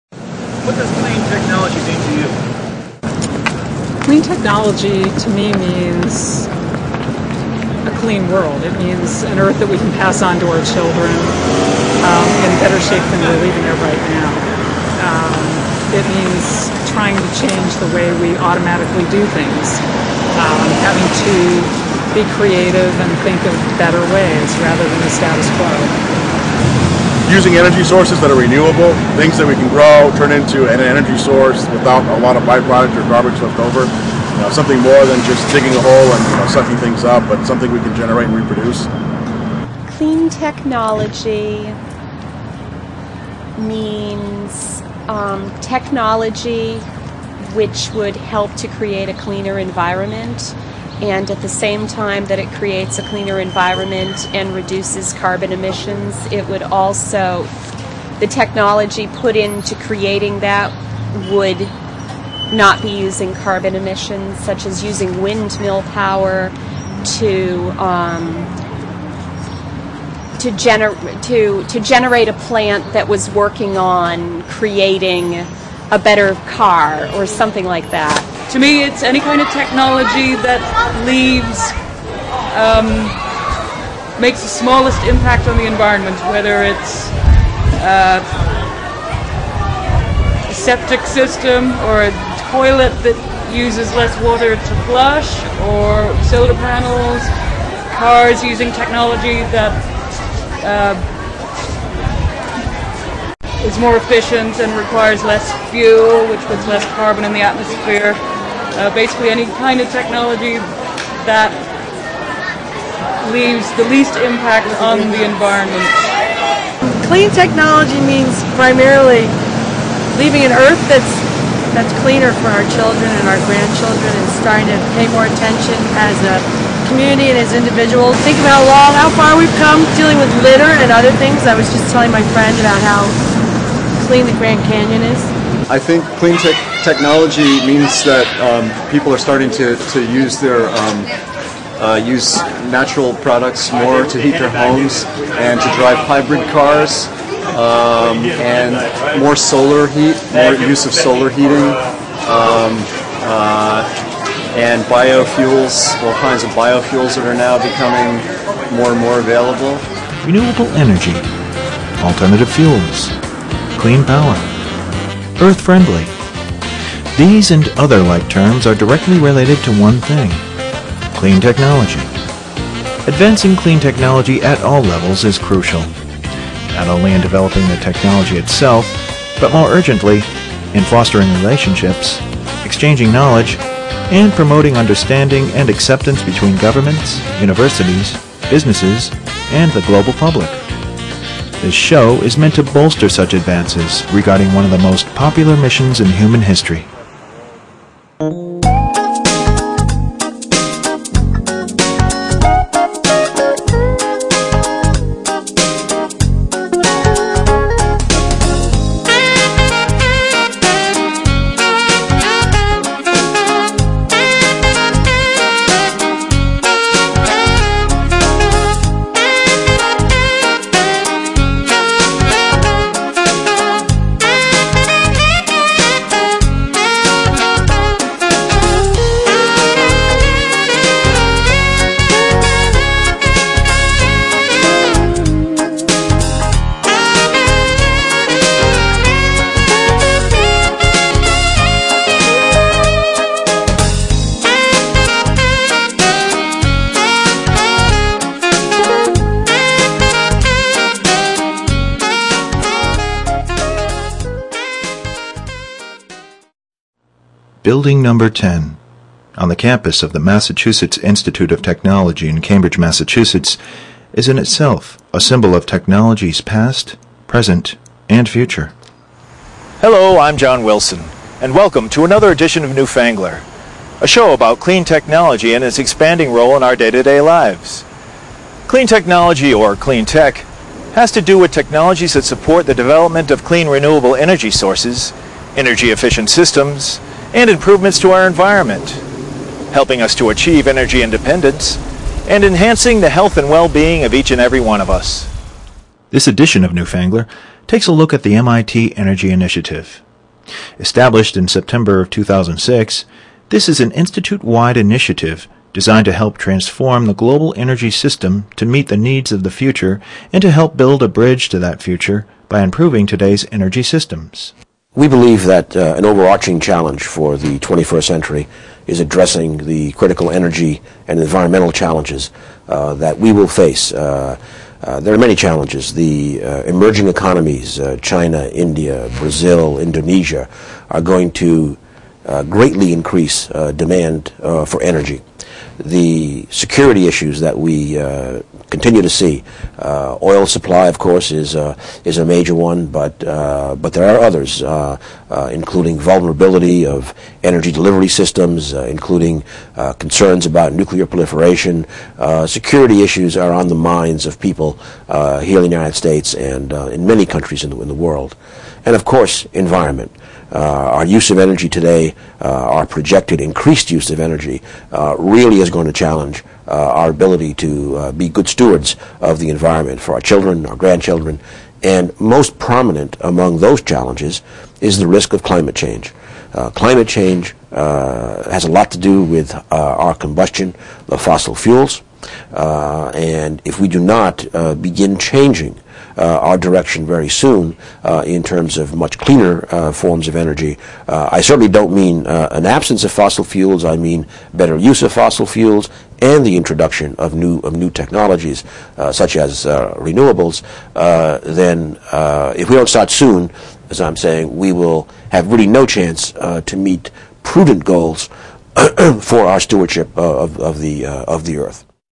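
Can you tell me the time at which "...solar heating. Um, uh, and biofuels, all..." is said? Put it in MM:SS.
02:30.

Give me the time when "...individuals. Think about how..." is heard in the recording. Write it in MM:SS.
02:07.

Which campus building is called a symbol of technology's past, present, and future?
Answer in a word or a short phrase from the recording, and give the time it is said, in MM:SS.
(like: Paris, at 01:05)
Building Number 10, at 04:17.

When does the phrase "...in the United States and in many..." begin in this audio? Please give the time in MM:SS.
05:55.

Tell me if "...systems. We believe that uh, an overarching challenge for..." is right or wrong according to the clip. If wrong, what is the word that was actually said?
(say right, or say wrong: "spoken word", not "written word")
right.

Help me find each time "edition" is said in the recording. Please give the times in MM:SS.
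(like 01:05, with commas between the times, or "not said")
04:32, 04:56.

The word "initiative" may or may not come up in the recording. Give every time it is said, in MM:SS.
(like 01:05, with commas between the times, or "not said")
04:59, 05:04.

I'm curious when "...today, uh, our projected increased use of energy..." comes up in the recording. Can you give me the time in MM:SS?
06:01.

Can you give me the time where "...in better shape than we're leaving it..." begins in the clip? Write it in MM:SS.
00:12.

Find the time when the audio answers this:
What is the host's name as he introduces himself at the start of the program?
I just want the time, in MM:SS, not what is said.
04:30.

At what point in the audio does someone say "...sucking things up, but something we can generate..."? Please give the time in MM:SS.
00:36.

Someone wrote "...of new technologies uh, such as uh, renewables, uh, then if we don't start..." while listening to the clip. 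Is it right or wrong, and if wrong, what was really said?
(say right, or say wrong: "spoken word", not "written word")
right.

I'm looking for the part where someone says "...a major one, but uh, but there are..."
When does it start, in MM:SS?
05:42.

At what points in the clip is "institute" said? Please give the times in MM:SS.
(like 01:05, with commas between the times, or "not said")
04:20, 05:03.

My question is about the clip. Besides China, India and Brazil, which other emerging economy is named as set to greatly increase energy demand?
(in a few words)
Indonesia.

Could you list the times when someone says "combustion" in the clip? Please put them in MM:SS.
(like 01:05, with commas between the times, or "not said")
06:20.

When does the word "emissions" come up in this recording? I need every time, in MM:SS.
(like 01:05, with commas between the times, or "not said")
00:55, 01:03.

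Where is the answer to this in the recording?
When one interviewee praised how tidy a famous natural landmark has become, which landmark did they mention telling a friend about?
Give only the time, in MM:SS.
02:14.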